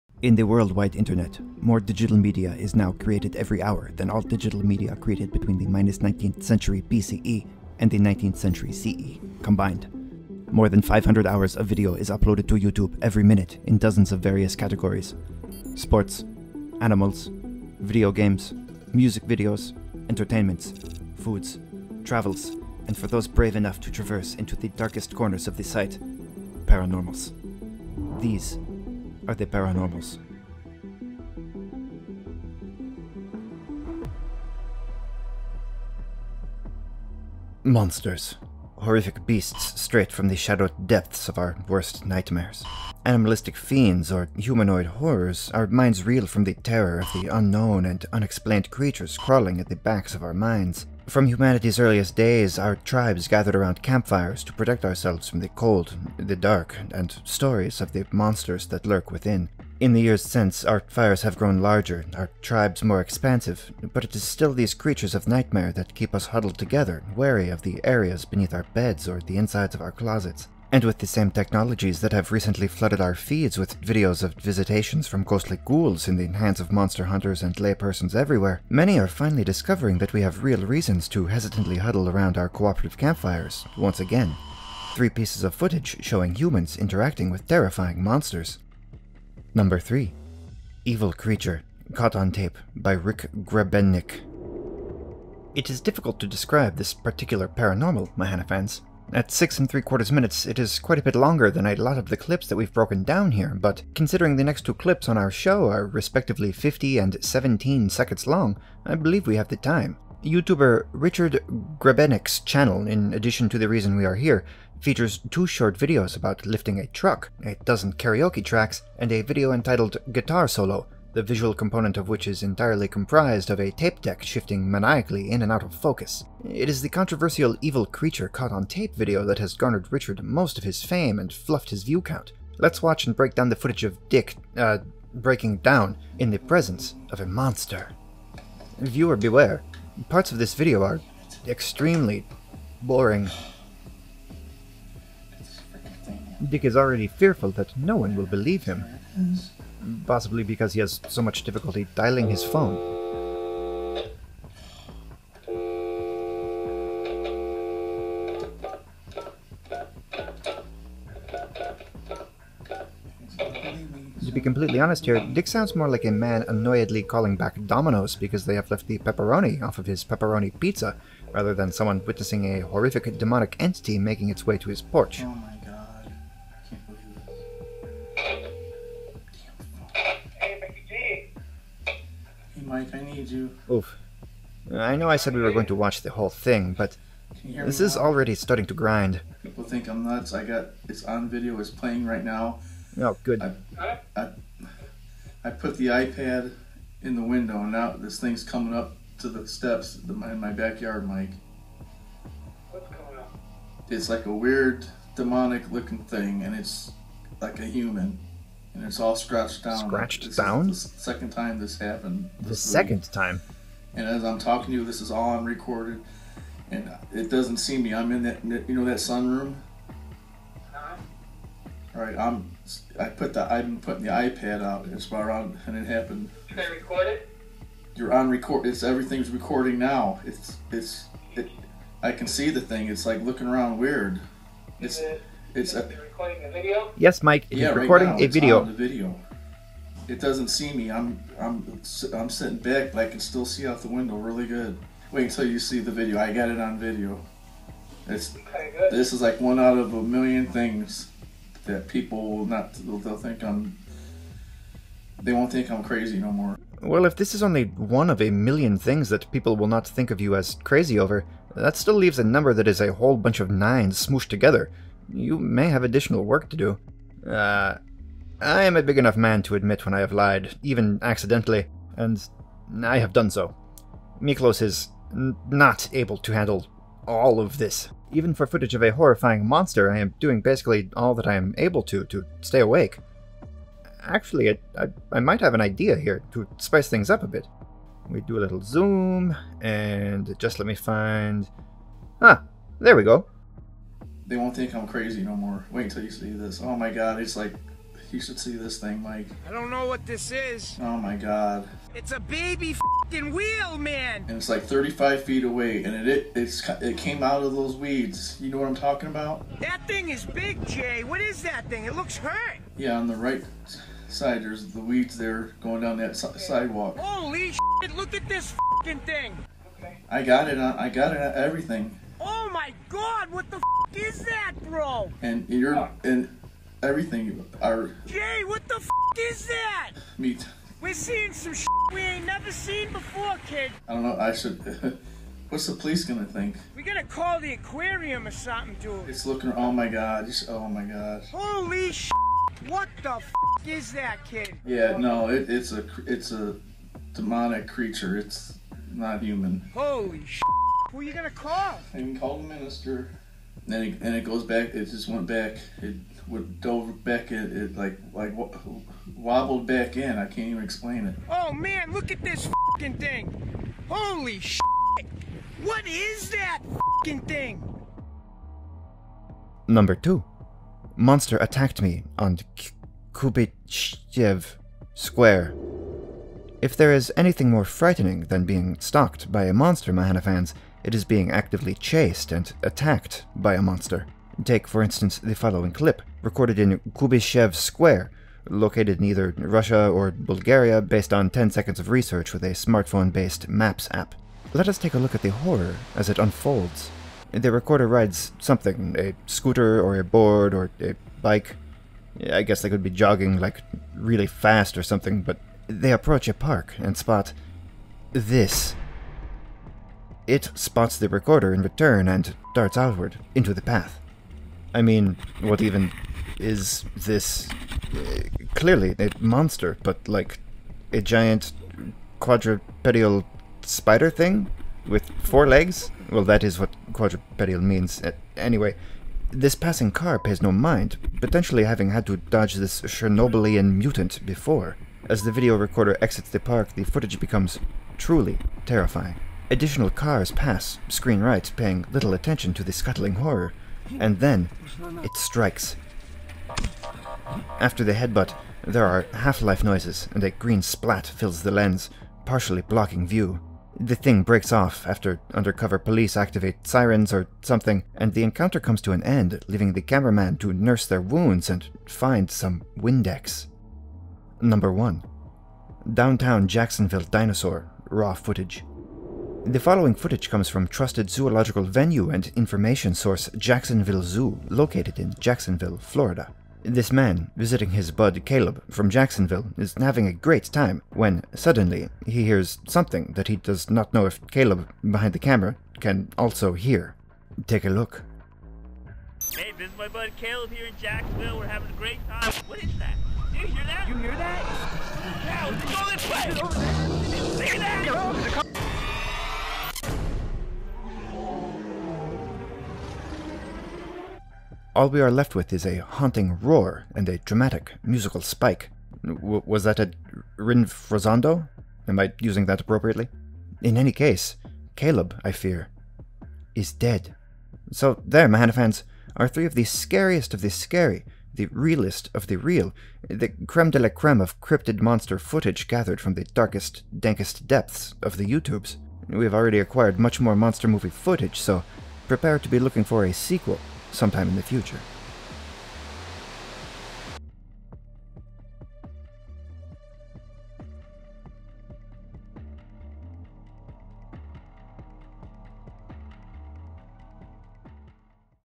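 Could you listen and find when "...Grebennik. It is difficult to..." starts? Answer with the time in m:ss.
1:33.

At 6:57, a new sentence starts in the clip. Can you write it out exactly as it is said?
Uh, clearly a monster, but like a giant quadrupedal spider thing with four legs?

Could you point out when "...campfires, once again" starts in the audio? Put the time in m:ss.
1:22.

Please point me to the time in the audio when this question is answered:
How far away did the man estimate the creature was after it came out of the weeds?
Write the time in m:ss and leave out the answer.
5:04.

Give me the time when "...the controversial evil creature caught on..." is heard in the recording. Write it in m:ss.
2:06.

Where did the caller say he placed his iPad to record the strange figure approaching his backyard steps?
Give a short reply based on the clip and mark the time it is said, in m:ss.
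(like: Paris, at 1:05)
In the window, at 3:17.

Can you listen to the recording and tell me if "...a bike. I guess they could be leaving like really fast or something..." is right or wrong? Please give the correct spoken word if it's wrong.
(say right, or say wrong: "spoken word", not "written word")
wrong: "jogging", not "leaving".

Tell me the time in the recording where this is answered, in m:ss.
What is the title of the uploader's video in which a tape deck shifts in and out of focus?
2:00.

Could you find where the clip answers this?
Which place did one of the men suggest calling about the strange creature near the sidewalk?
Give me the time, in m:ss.
5:37.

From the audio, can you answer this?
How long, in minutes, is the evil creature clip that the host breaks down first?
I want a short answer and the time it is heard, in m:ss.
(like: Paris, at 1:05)
6 3/4 minutes, at 1:39.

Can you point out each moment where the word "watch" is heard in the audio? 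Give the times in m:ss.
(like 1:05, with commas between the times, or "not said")
2:12, 3:05.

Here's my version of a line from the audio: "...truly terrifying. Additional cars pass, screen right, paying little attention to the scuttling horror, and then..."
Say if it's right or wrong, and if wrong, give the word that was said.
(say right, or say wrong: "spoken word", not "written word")
right.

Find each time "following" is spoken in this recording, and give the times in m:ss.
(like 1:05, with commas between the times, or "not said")
6:25, 7:49.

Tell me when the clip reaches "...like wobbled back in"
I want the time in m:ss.
5:58.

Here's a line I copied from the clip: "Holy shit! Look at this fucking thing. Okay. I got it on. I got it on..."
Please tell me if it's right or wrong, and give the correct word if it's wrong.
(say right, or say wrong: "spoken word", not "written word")
right.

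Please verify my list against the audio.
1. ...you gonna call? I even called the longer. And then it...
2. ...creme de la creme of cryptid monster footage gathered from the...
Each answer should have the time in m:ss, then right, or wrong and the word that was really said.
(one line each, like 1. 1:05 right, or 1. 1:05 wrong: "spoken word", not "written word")
1. 5:51 wrong: "minister", not "longer"
2. 8:43 right.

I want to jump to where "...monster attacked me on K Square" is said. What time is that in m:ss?
6:10.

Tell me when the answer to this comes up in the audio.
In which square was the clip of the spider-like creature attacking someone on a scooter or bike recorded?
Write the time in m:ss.
6:26.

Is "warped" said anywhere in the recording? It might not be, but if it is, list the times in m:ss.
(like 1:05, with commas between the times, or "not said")
not said.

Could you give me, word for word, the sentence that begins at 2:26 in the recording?
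Dick is already fearful that no one will believe him.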